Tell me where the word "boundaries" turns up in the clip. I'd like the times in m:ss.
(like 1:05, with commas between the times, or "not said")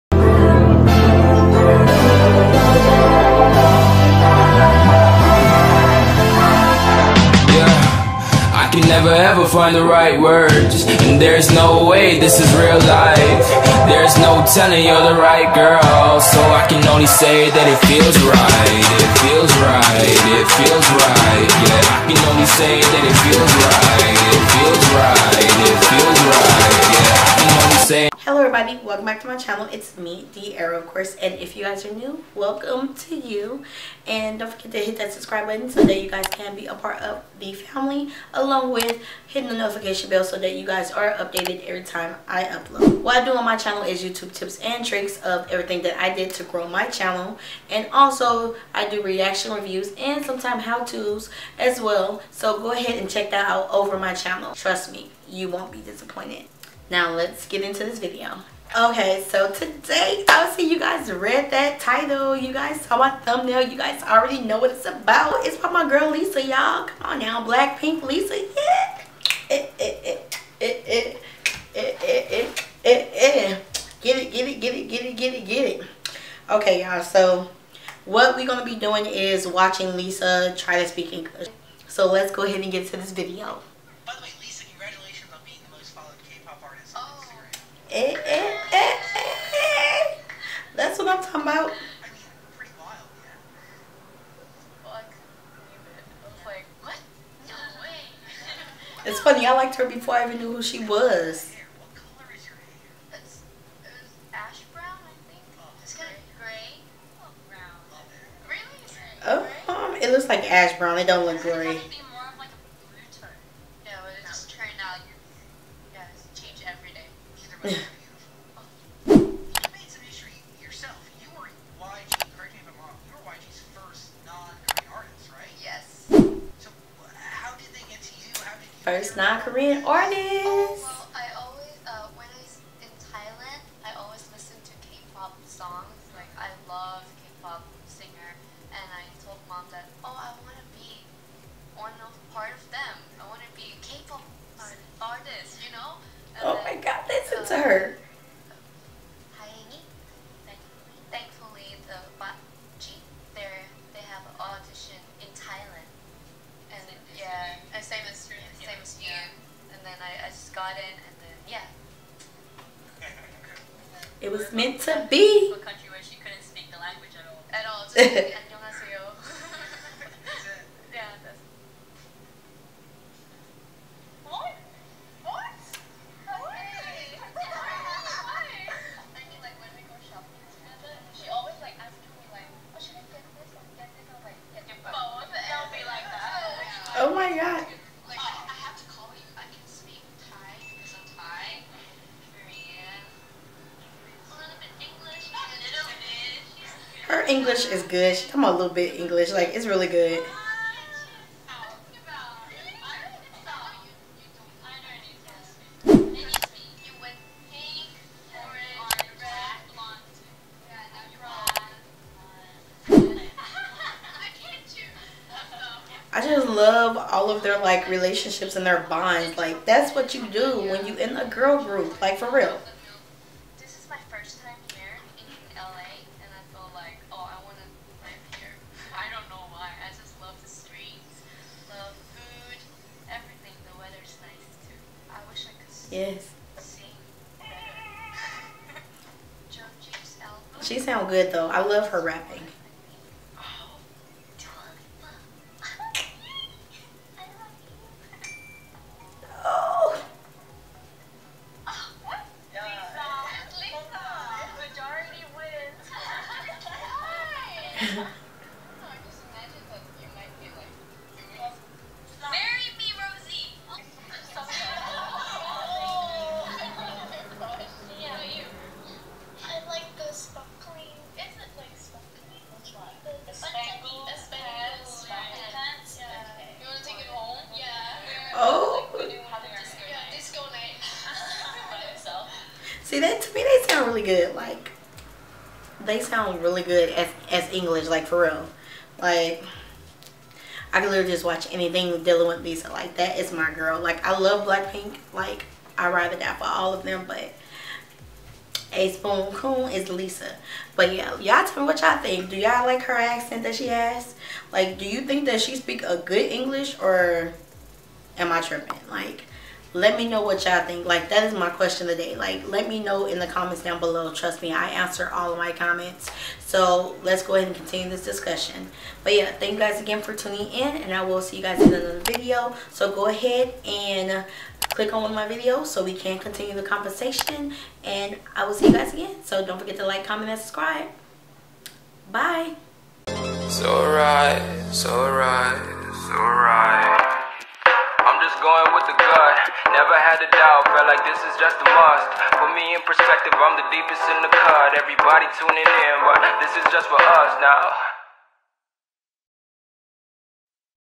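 not said.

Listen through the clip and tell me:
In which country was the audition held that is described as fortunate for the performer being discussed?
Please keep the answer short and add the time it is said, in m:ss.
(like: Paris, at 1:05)
Thailand, at 2:35.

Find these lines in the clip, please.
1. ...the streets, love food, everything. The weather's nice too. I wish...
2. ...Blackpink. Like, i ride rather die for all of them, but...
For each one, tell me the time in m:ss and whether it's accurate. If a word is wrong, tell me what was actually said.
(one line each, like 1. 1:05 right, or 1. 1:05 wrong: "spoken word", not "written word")
1. 3:50 right
2. 4:54 right.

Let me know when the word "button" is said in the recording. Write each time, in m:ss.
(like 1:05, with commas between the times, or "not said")
0:35.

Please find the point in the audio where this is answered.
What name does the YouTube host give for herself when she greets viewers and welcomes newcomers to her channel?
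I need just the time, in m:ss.
0:30.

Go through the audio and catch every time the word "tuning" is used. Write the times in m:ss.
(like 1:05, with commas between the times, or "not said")
5:20, 5:45.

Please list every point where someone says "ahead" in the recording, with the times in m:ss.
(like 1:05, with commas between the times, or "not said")
0:52, 1:22, 5:17, 5:23.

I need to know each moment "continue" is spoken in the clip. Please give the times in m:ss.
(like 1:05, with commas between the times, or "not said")
5:17, 5:26.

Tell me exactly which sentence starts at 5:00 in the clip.
But yeah, y'all tell me what y'all think.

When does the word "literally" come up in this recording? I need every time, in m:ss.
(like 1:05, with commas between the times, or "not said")
4:50.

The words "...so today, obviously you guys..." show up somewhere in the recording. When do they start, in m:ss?
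0:59.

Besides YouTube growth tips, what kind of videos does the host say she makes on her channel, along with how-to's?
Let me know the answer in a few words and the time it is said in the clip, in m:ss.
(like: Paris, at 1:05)
Reaction reviews, at 0:49.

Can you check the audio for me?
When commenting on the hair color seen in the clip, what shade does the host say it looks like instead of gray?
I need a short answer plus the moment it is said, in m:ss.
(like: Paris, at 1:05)
Ash brown, at 1:50.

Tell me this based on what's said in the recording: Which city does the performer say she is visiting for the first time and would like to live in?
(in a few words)
LA.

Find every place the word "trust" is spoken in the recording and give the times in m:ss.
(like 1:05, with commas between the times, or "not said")
0:54, 5:14.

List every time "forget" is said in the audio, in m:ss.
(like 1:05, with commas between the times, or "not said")
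0:34, 5:29.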